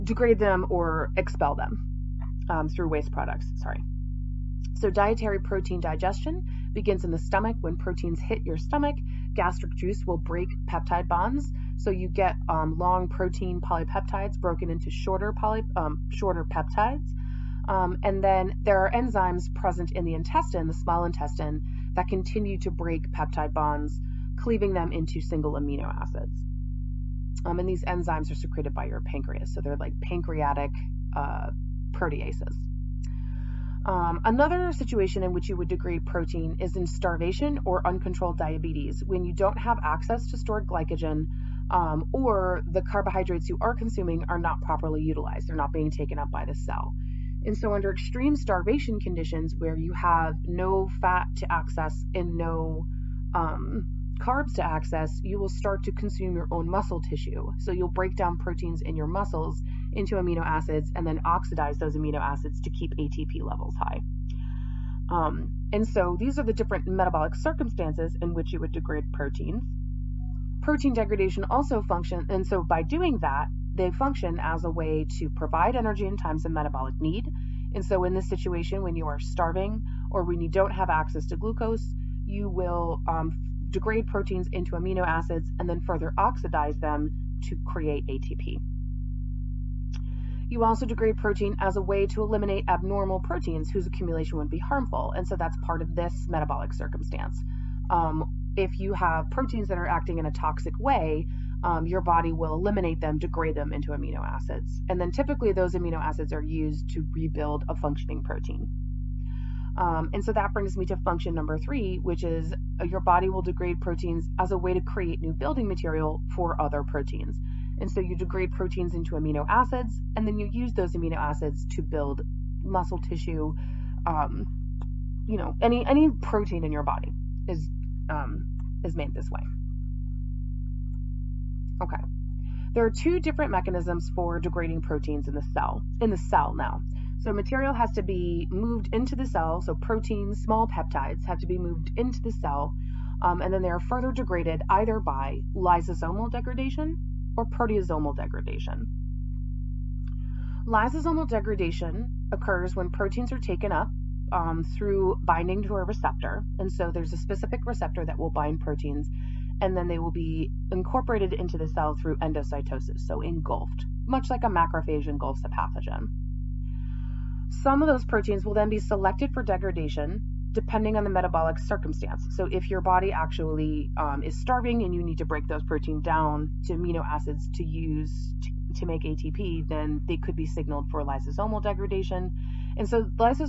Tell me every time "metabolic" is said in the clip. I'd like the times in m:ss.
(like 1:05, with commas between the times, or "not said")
1:06, 1:16, 1:36, 2:51.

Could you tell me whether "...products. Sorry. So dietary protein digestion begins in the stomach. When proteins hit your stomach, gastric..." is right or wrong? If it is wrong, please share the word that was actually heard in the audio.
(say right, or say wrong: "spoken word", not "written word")
right.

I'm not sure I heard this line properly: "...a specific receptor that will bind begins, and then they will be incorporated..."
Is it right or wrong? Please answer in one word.
wrong.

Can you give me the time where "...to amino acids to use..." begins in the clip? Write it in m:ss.
2:56.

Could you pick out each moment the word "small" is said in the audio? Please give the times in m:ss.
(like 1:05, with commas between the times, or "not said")
0:20, 2:20.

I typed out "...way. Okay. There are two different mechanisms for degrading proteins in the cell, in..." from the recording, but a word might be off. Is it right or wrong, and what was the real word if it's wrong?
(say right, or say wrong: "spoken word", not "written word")
right.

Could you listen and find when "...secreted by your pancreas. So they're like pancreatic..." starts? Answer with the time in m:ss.
0:28.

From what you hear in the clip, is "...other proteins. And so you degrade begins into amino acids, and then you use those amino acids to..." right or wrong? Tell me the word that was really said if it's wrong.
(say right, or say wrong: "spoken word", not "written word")
wrong: "proteins", not "begins".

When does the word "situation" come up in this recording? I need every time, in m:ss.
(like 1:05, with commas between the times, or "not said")
0:34, 1:18.